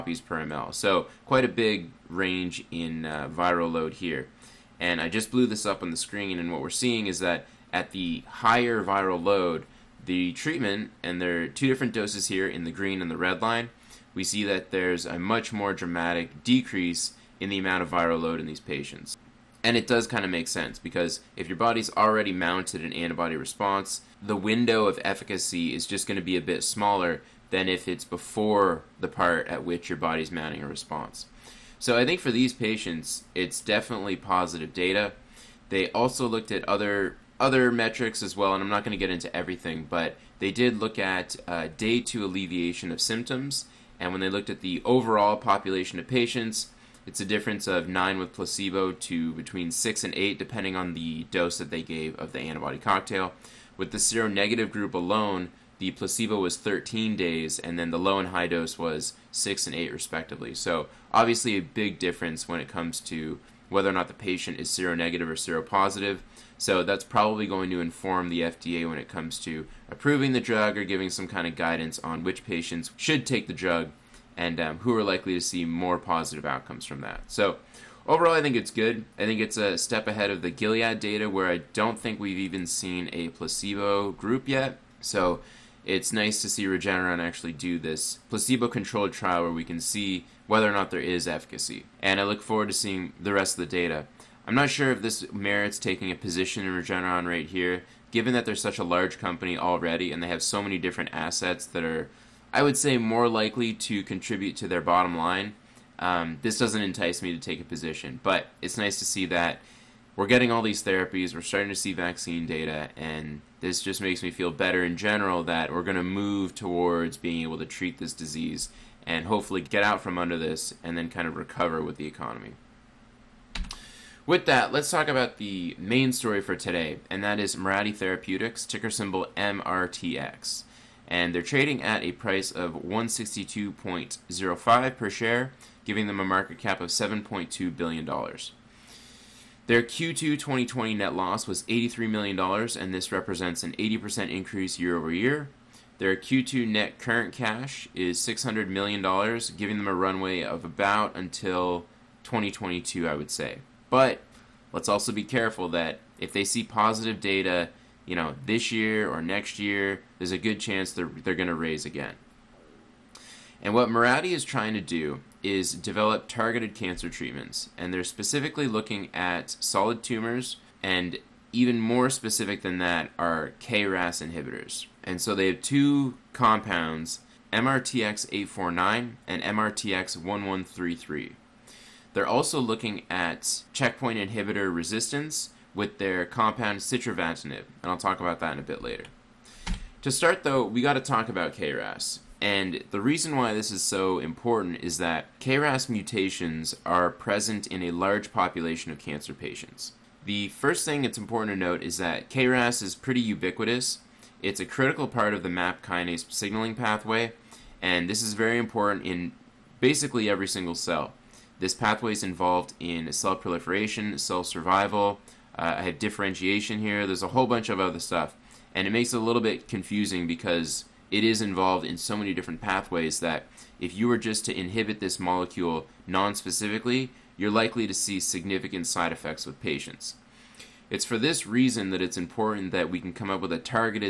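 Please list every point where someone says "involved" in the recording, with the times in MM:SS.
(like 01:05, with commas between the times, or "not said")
03:32, 03:41.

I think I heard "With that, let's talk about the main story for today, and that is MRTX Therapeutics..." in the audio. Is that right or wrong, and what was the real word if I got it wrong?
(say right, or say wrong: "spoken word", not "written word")
wrong: "Mirati", not "MRTX".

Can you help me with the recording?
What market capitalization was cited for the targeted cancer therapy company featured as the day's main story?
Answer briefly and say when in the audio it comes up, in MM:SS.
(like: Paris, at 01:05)
$7.2 billion, at 02:16.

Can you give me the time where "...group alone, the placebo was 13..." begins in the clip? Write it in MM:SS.
00:54.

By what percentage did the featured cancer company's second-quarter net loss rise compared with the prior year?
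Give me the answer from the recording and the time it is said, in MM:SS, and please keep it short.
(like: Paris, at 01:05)
80%, at 02:23.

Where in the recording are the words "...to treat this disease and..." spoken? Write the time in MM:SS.
01:57.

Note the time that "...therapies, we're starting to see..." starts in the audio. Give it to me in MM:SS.
01:50.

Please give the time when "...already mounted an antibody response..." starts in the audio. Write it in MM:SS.
00:21.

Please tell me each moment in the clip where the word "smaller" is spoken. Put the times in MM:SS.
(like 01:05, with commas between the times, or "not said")
00:26.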